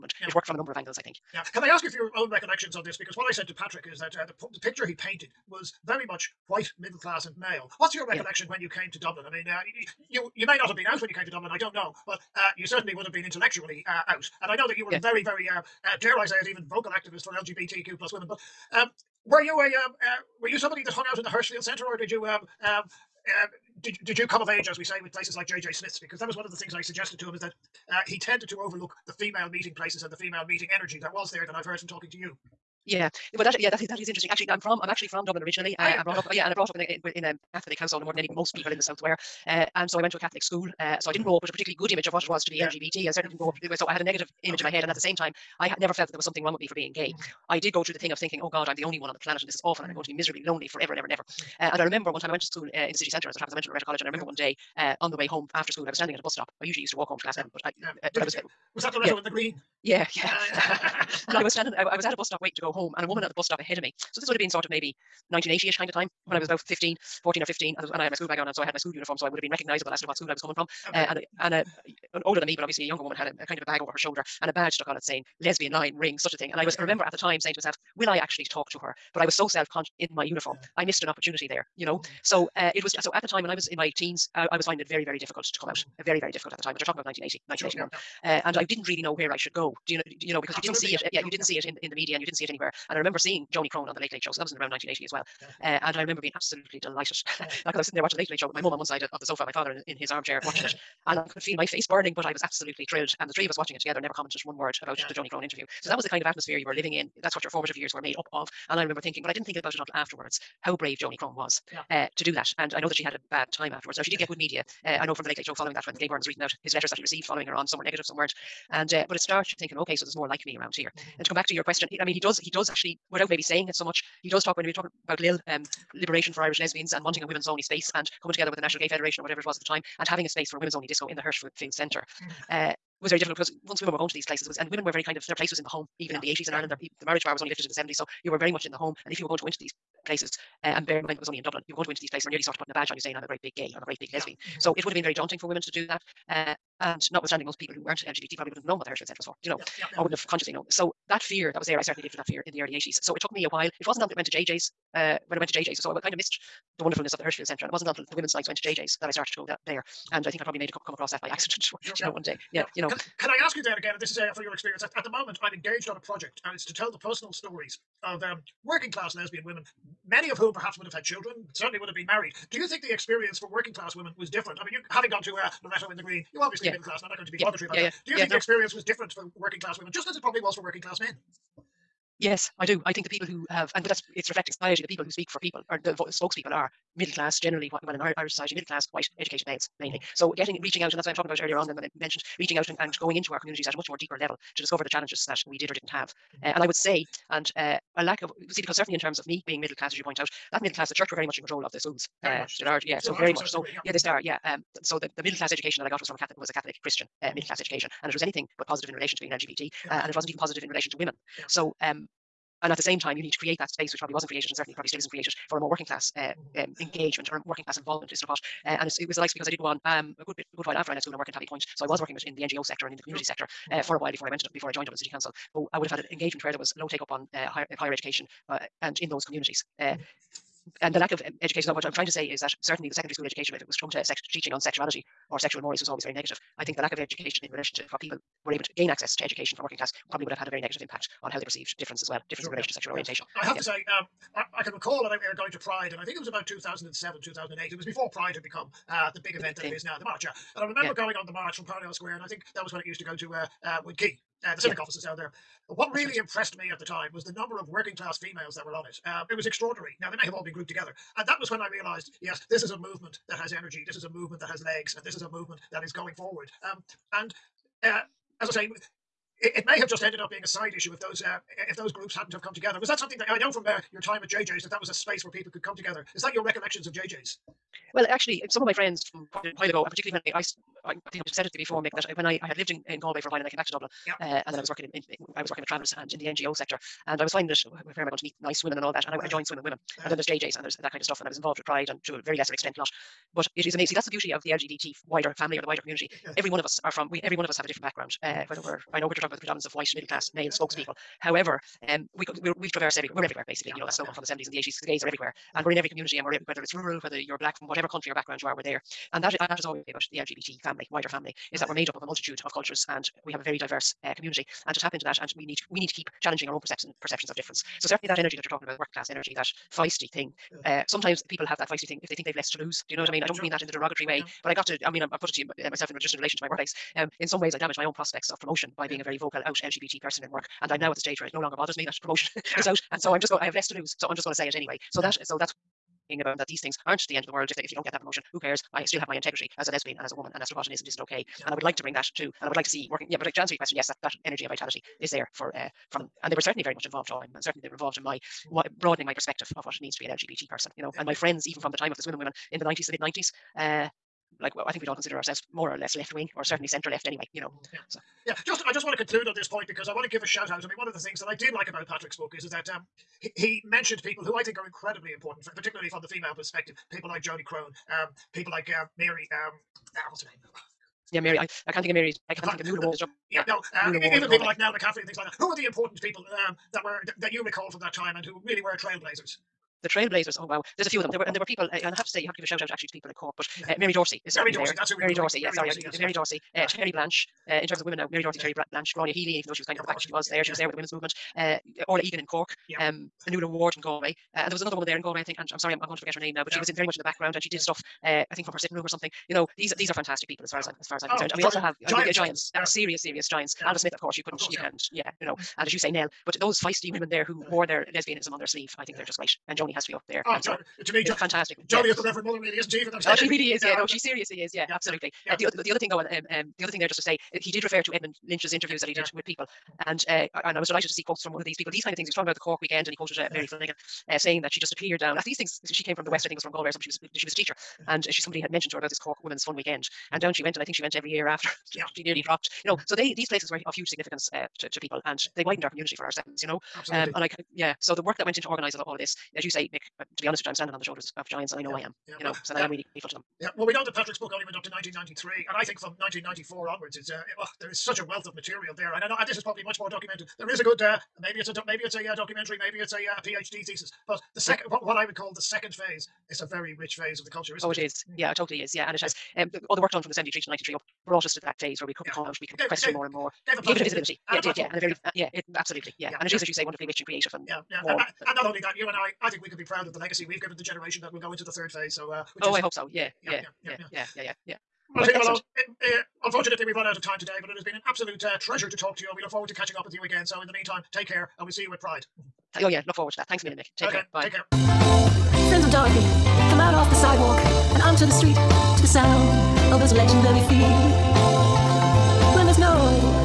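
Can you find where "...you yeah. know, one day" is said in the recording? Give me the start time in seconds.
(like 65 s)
161 s.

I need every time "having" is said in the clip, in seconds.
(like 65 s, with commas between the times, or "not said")
130 s, 174 s.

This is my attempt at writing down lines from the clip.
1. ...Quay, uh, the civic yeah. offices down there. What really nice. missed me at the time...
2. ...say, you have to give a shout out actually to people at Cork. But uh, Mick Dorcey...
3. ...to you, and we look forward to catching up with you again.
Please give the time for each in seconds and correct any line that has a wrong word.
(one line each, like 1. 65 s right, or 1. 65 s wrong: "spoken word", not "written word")
1. 253 s wrong: "impressed", not "missed"
2. 382 s wrong: "Mary", not "Mick"
3. 478 s right.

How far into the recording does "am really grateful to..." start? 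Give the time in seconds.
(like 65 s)
442 s.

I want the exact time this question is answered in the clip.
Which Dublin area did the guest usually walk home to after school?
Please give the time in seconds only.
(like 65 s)
57 s.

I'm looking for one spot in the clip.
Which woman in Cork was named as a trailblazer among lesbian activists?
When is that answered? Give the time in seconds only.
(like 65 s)
391 s.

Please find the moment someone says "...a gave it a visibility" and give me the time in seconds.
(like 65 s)
463 s.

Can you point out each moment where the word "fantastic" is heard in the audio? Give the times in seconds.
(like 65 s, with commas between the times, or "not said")
399 s, 411 s.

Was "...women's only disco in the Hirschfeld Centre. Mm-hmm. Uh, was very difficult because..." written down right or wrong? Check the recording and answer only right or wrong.
right.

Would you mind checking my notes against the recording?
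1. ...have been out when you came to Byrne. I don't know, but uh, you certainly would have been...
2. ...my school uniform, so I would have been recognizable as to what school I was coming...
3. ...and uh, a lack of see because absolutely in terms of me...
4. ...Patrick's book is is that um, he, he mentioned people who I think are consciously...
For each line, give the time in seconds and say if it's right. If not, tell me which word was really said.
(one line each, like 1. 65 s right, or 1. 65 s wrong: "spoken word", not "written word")
1. 10 s wrong: "Dublin", not "Byrne"
2. 68 s right
3. 197 s wrong: "certainly", not "absolutely"
4. 361 s wrong: "incredibly", not "consciously".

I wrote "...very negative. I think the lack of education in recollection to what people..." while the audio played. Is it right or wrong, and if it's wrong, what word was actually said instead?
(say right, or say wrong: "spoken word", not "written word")
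wrong: "relation", not "recollection".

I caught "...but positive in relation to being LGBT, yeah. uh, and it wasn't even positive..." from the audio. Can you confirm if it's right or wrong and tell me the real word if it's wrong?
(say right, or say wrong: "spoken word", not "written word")
right.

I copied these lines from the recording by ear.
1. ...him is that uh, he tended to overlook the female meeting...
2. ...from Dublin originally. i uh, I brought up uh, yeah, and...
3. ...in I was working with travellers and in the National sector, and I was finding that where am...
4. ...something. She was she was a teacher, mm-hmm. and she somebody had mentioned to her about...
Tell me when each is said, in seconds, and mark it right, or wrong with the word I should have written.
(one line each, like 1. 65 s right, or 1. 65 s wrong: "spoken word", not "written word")
1. 27 s right
2. 35 s right
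3. 284 s wrong: "NGO", not "National"
4. 426 s right.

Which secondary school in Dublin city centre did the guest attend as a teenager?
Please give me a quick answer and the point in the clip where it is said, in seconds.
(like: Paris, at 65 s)
Loreto College, at 53 s.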